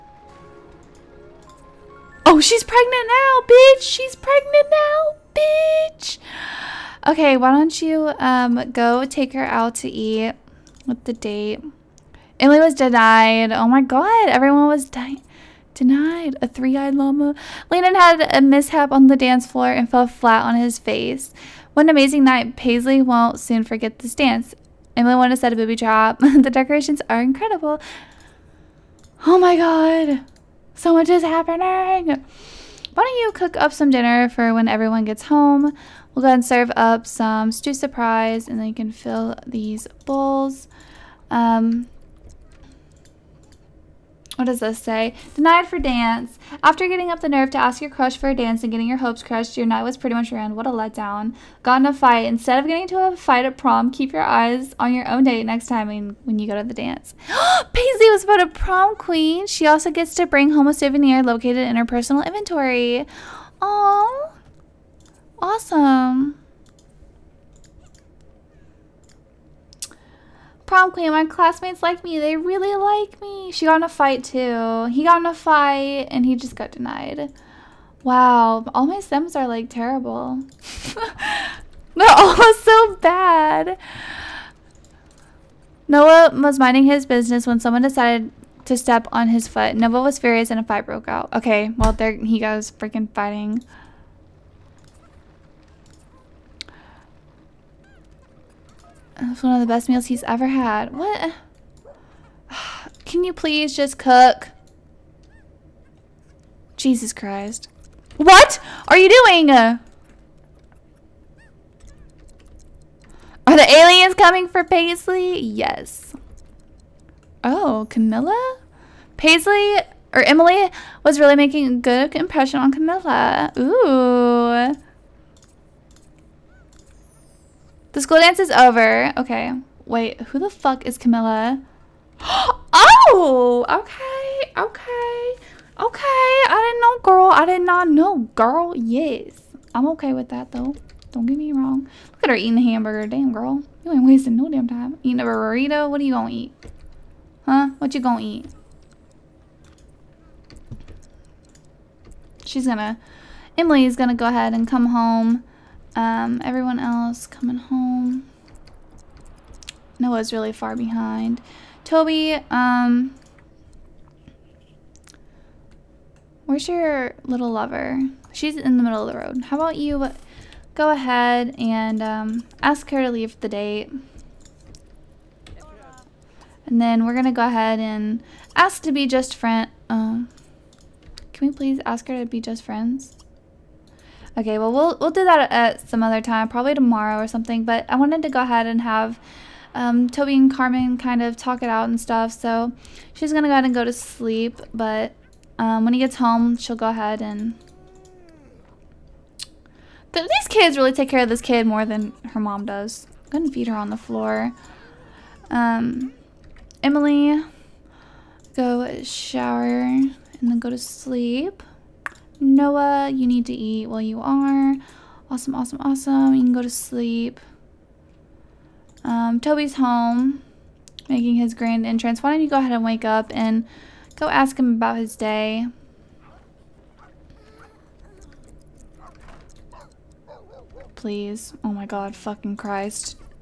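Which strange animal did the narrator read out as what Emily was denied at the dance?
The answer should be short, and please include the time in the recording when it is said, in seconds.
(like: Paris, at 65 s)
Three eyed llama, at 16 s.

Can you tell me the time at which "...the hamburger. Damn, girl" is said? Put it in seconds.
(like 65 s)
142 s.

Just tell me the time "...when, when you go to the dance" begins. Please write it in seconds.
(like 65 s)
55 s.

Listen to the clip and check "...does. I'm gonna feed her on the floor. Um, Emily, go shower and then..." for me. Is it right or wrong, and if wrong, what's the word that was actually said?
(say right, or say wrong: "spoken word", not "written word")
right.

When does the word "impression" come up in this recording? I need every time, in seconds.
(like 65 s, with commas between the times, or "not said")
122 s.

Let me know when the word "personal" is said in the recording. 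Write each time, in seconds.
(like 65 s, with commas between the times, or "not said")
61 s.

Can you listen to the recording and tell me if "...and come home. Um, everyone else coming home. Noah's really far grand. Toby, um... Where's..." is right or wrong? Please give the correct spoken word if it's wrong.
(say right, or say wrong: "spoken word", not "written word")
wrong: "behind", not "grand".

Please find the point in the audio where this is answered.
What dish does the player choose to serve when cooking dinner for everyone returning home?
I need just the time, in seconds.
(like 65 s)
37 s.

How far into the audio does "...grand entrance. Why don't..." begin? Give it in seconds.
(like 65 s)
221 s.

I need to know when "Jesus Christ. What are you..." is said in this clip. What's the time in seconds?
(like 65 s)
106 s.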